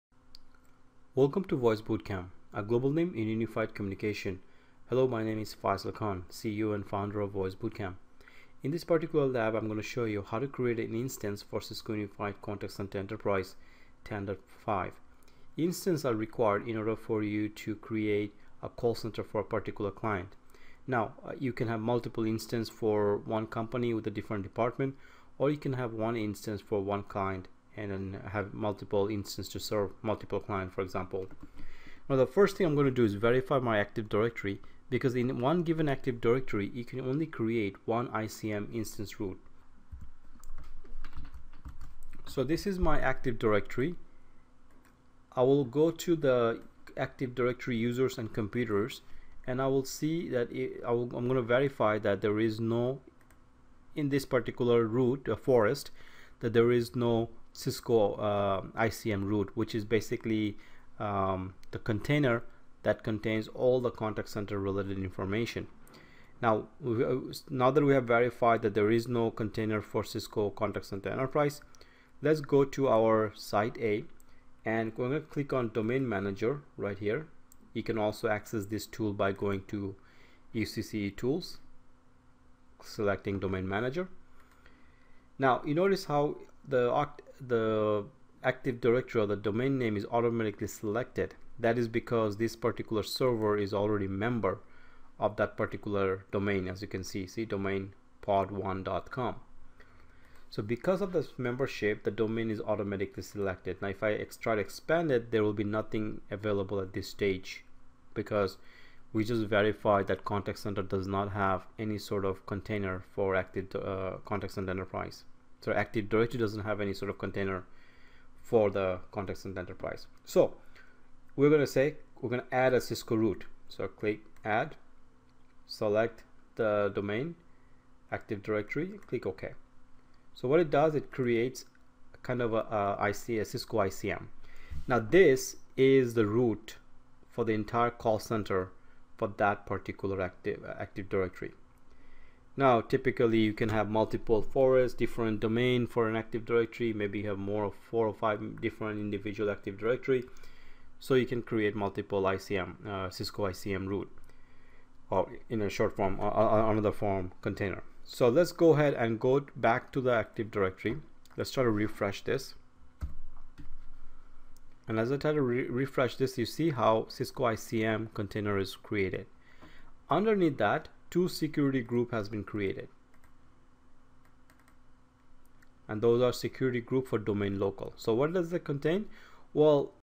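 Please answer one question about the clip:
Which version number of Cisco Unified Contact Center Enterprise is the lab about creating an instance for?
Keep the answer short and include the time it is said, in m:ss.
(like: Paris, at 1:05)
10.5, at 0:14.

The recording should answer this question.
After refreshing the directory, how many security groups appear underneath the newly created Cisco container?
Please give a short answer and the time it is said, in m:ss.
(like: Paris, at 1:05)
2, at 2:51.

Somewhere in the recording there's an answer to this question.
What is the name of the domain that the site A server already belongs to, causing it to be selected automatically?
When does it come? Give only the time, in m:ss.
1:38.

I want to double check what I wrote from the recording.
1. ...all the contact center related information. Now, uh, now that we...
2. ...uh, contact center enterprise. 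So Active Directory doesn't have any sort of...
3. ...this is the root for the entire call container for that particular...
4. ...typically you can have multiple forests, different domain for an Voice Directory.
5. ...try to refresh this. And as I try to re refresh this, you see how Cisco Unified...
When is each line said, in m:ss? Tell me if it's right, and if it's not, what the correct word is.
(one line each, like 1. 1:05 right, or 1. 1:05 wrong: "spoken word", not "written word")
1. 1:03 right
2. 1:53 right
3. 2:14 wrong: "center", not "container"
4. 2:22 wrong: "Active", not "Voice"
5. 2:41 wrong: "ICM", not "Unified".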